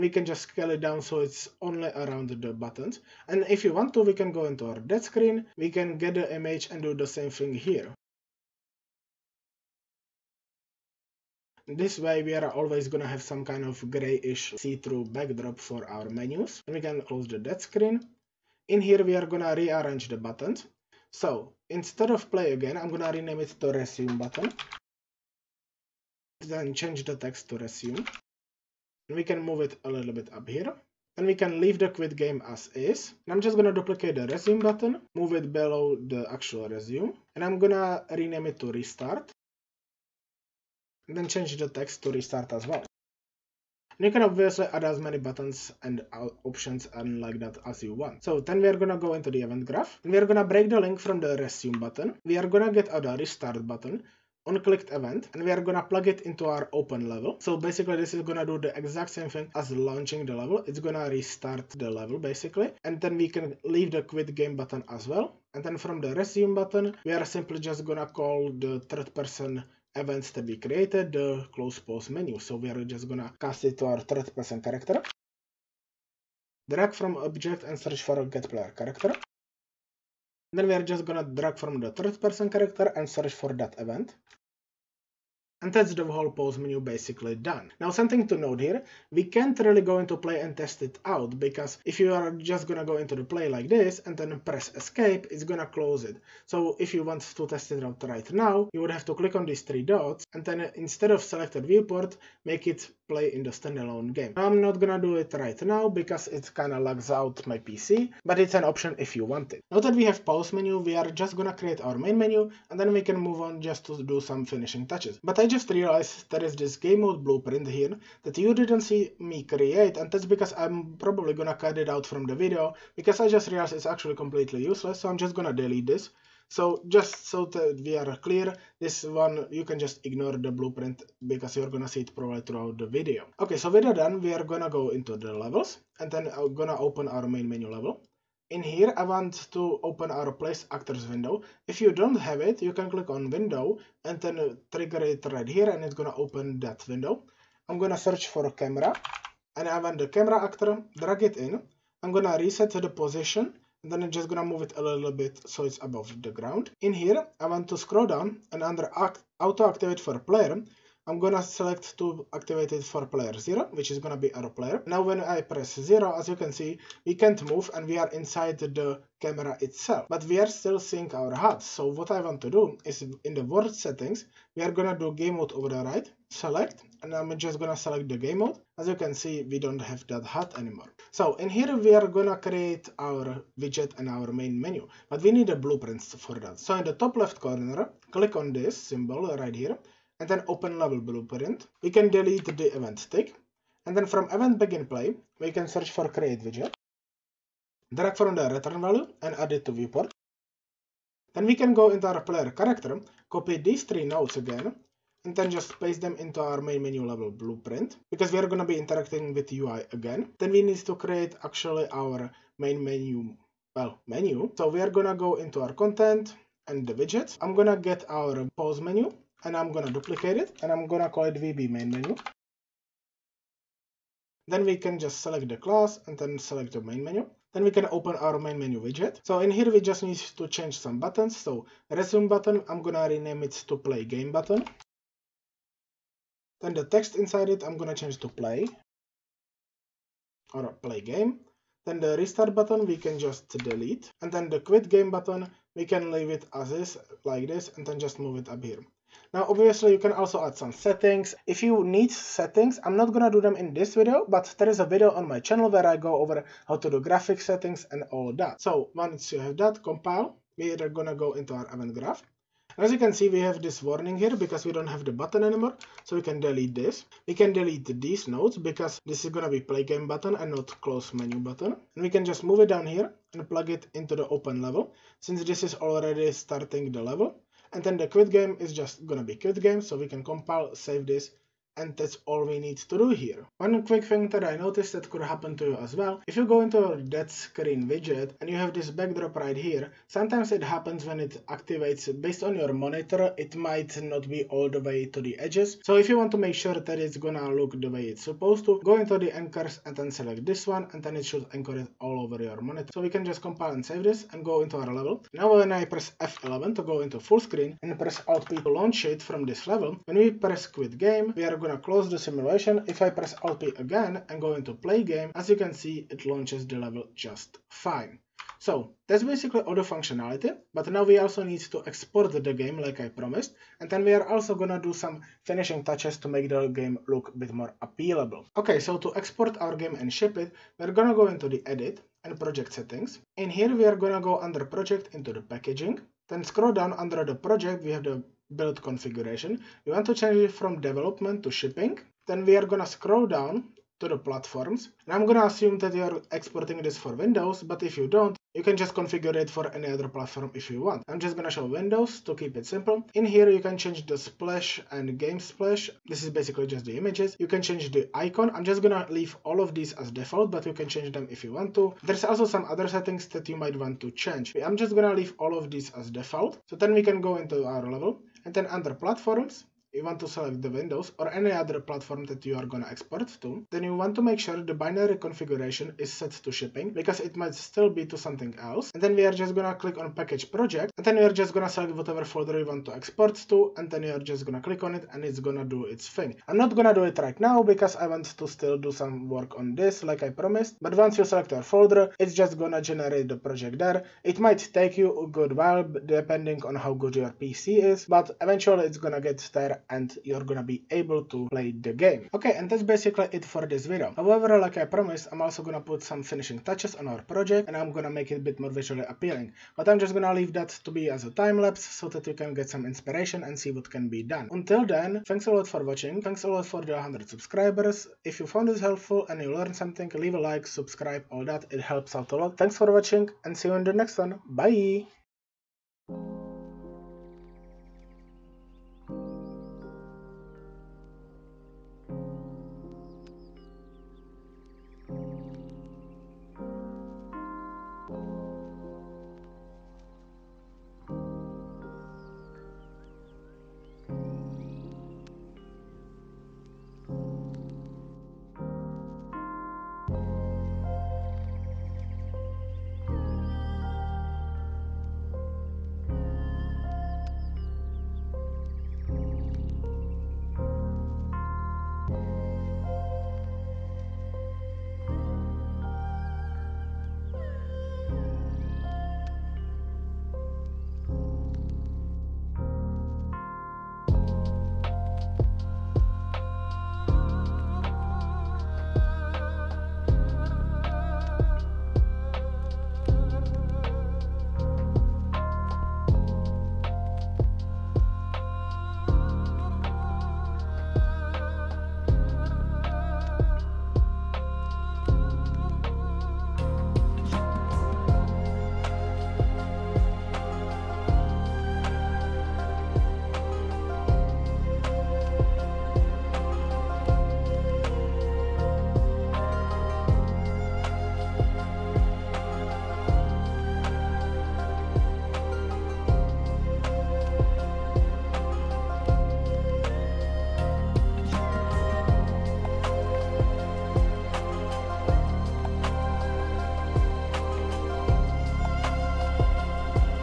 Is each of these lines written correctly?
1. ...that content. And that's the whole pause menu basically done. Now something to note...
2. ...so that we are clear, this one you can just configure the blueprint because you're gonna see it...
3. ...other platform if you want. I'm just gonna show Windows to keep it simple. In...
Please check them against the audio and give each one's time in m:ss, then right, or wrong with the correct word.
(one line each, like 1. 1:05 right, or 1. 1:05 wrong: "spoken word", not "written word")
1. 1:23 wrong: "event", not "content"
2. 2:07 wrong: "ignore", not "configure"
3. 5:49 right.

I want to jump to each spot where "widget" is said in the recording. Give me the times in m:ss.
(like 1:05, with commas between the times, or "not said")
3:03, 3:16, 3:36, 3:48, 4:47.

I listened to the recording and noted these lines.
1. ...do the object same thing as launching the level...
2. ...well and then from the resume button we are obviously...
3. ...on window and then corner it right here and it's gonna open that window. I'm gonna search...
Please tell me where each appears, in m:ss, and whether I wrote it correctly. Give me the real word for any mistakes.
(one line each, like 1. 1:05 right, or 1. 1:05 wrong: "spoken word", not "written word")
1. 0:58 wrong: "exact", not "object"
2. 1:05 wrong: "simply", not "obviously"
3. 2:23 wrong: "trigger", not "corner".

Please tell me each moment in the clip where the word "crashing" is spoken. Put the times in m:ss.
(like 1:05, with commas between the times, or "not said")
not said.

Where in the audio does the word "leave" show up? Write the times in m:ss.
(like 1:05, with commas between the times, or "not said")
0:31, 1:03, 4:06, 5:59, 6:05, 6:50, 7:00.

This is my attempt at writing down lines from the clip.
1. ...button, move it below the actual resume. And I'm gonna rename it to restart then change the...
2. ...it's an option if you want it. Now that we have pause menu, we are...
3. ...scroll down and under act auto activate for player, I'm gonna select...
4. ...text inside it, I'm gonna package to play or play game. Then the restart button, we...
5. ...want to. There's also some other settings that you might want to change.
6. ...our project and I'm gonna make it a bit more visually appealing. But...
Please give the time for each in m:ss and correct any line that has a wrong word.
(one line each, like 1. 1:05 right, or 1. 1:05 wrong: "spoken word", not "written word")
1. 0:34 right
2. 1:48 right
3. 2:37 right
4. 3:56 wrong: "change", not "package"
5. 6:01 right
6. 6:47 right.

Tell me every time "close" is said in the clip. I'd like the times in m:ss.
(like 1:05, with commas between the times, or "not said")
0:17, 1:11, 1:35, 4:30, 5:11.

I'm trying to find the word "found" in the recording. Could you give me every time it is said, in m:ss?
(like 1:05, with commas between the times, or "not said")
6:58.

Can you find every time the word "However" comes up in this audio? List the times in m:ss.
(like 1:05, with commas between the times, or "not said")
6:44.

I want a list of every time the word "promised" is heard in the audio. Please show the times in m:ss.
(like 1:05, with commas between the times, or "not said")
5:23, 6:30, 6:44.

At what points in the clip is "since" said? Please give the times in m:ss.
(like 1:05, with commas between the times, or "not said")
4:35.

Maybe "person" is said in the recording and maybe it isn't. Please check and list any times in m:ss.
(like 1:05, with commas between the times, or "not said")
1:09, 1:14, 1:22.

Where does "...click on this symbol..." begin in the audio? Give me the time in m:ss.
3:08.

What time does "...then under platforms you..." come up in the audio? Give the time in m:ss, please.
6:08.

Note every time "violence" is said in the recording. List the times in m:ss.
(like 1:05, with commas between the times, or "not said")
not said.